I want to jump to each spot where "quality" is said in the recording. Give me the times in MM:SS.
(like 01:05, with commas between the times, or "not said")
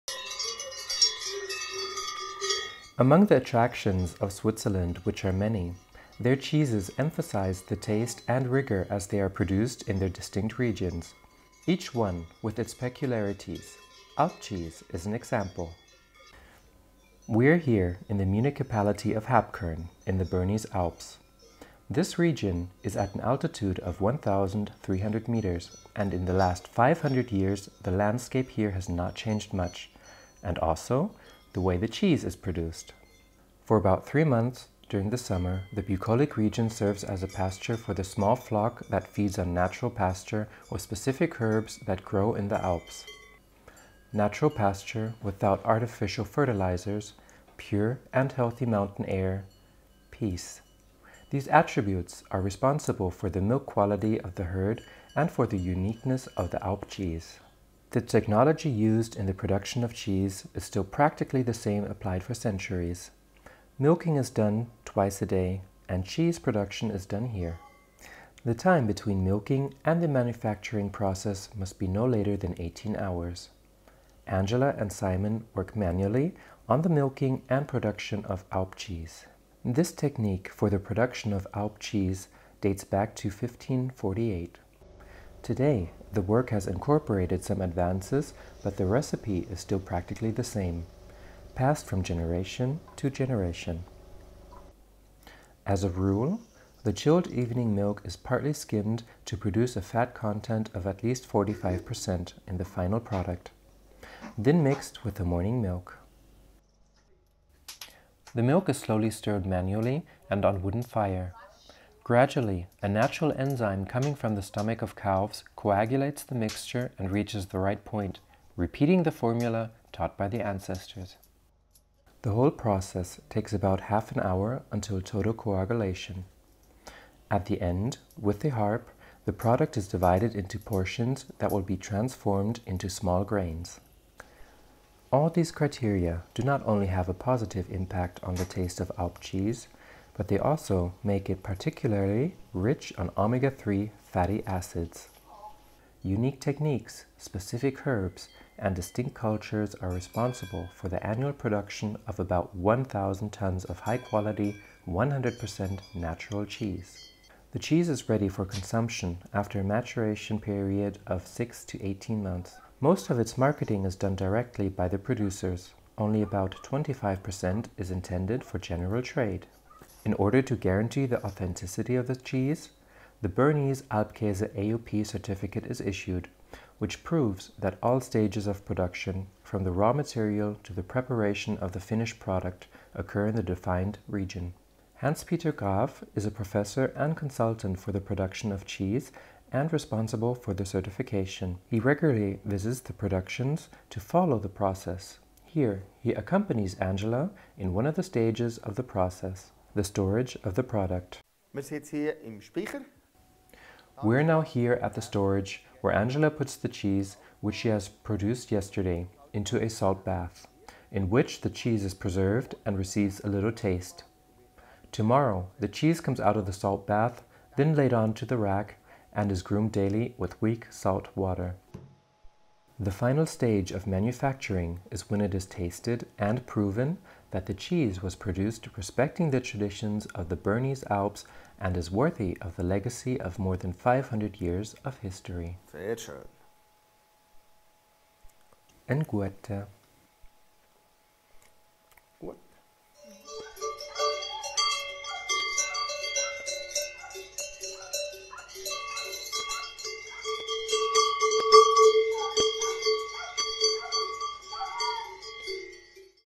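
00:53, 02:33.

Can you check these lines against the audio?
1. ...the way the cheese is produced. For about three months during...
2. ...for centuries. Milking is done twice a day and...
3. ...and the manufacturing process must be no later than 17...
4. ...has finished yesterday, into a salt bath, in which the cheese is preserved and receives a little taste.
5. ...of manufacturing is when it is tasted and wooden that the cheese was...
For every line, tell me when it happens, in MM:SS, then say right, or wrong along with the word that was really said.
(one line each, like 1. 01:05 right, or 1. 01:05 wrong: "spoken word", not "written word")
1. 00:31 right
2. 01:02 right
3. 01:09 wrong: "18", not "17"
4. 03:27 wrong: "produced", not "finished"
5. 03:43 wrong: "proven", not "wooden".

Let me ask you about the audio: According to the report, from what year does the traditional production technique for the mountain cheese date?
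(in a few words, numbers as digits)
1548.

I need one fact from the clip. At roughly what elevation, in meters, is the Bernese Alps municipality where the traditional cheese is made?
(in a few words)
1,300 meters.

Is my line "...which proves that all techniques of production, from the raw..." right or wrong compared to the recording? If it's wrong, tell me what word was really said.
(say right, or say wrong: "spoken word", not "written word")
wrong: "stages", not "techniques".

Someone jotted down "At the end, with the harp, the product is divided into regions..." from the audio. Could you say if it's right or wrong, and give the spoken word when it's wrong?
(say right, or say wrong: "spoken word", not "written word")
wrong: "portions", not "regions".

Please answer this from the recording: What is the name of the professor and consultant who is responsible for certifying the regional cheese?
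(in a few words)
Hans-Peter Graf.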